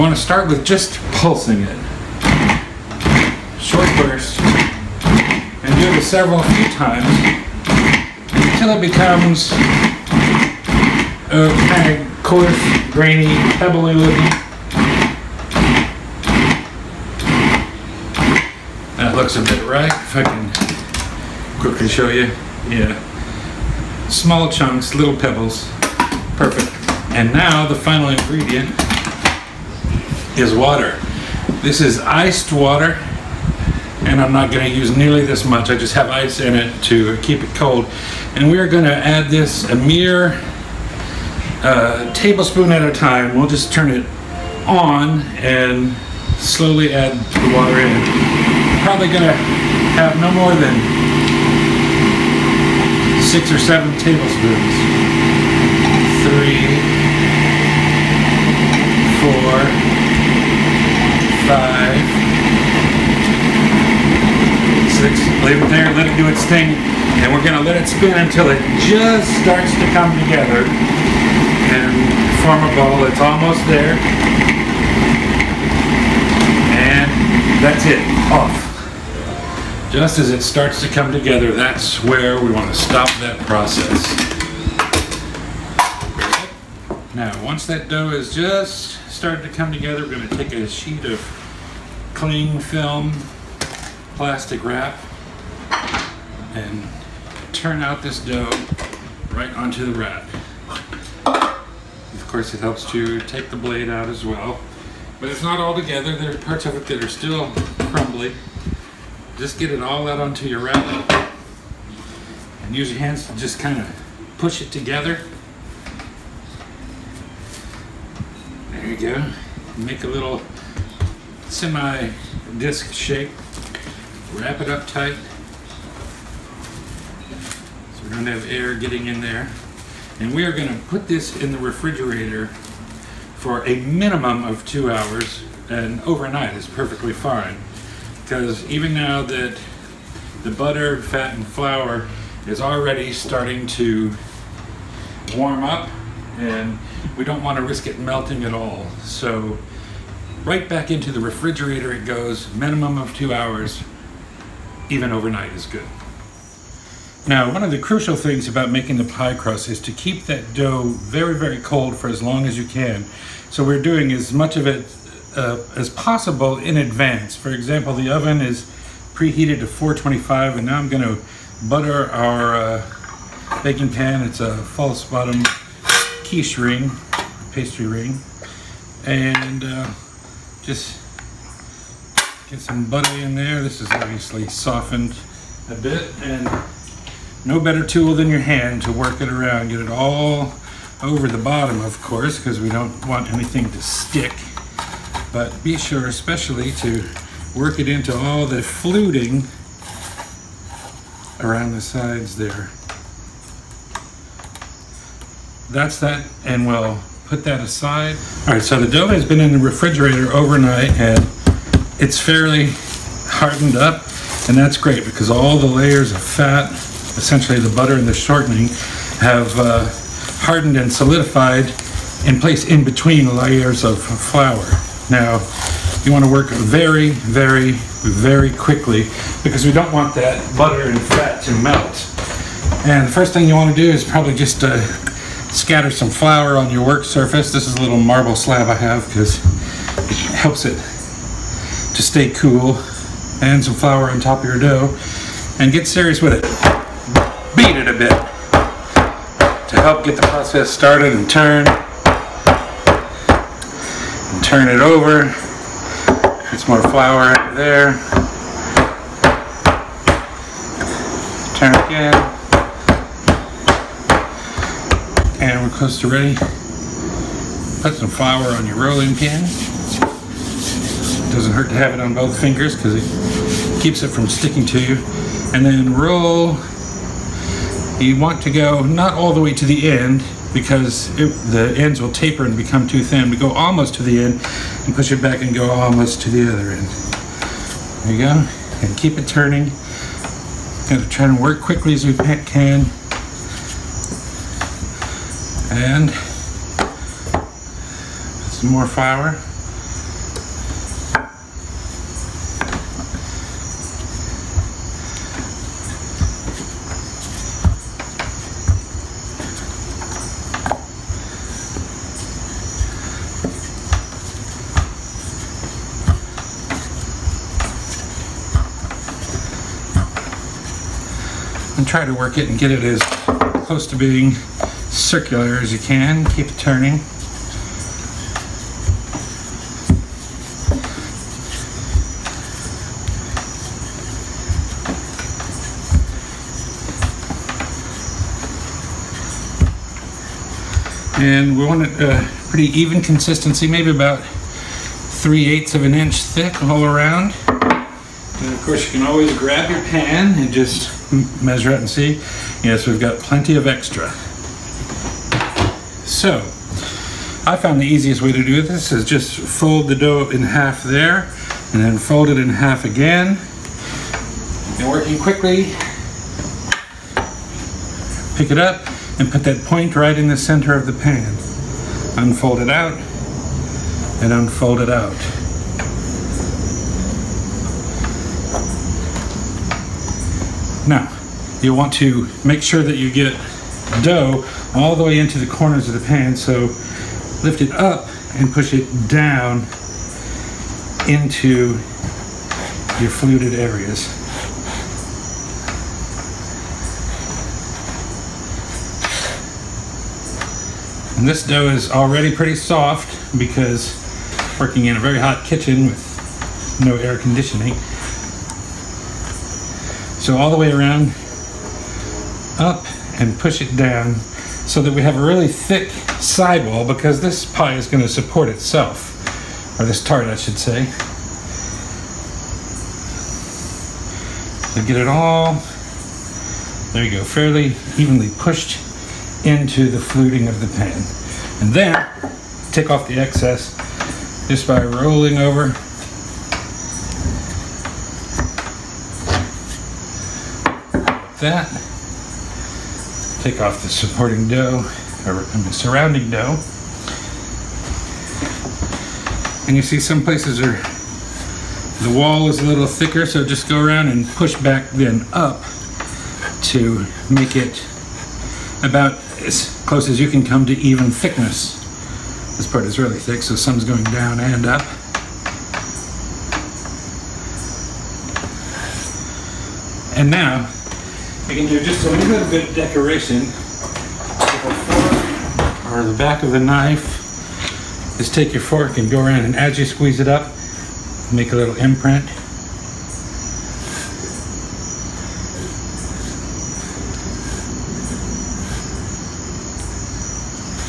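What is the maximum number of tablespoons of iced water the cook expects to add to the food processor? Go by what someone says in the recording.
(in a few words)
7.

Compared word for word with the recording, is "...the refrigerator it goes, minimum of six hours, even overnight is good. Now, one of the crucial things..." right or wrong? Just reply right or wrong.
wrong.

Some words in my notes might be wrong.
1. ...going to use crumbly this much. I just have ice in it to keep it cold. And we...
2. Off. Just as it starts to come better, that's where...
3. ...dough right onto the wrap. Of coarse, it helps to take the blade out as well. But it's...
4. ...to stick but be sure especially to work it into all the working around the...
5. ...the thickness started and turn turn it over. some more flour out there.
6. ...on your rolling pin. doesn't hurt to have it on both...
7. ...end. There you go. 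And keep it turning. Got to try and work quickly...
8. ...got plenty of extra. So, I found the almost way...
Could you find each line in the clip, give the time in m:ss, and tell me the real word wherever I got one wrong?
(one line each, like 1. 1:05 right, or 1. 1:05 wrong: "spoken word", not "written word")
1. 0:34 wrong: "nearly", not "crumbly"
2. 1:18 wrong: "together", not "better"
3. 1:38 wrong: "course", not "coarse"
4. 3:13 wrong: "fluting", not "working"
5. 4:10 wrong: "process", not "thickness"
6. 4:28 right
7. 4:46 right
8. 5:52 wrong: "easiest", not "almost".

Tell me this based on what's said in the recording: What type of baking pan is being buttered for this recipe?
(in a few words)
false bottom quiche ring.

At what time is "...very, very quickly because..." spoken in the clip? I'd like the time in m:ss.
3:47.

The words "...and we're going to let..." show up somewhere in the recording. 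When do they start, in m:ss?
1:07.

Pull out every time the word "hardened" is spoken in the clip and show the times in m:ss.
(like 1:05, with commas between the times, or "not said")
3:33, 3:40.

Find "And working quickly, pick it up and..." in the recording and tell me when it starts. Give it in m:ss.
6:04.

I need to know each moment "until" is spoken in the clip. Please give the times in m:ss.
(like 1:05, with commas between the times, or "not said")
0:08, 1:08.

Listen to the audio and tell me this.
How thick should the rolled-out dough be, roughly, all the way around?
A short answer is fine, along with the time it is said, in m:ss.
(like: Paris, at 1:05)
3/8 inch, at 5:44.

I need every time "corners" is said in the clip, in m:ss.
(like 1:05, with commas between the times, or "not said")
6:25.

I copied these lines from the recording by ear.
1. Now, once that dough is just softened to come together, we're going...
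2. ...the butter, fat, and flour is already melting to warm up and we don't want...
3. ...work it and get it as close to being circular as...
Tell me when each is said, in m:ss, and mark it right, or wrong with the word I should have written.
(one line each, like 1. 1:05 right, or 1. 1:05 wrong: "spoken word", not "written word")
1. 1:27 wrong: "started", not "softened"
2. 2:20 wrong: "starting", not "melting"
3. 5:22 right.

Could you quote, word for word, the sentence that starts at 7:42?
This part is really thick, so some's going down and up.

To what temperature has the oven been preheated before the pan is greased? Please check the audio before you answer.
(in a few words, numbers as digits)
425.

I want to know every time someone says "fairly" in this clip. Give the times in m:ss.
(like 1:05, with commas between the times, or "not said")
3:32, 7:07.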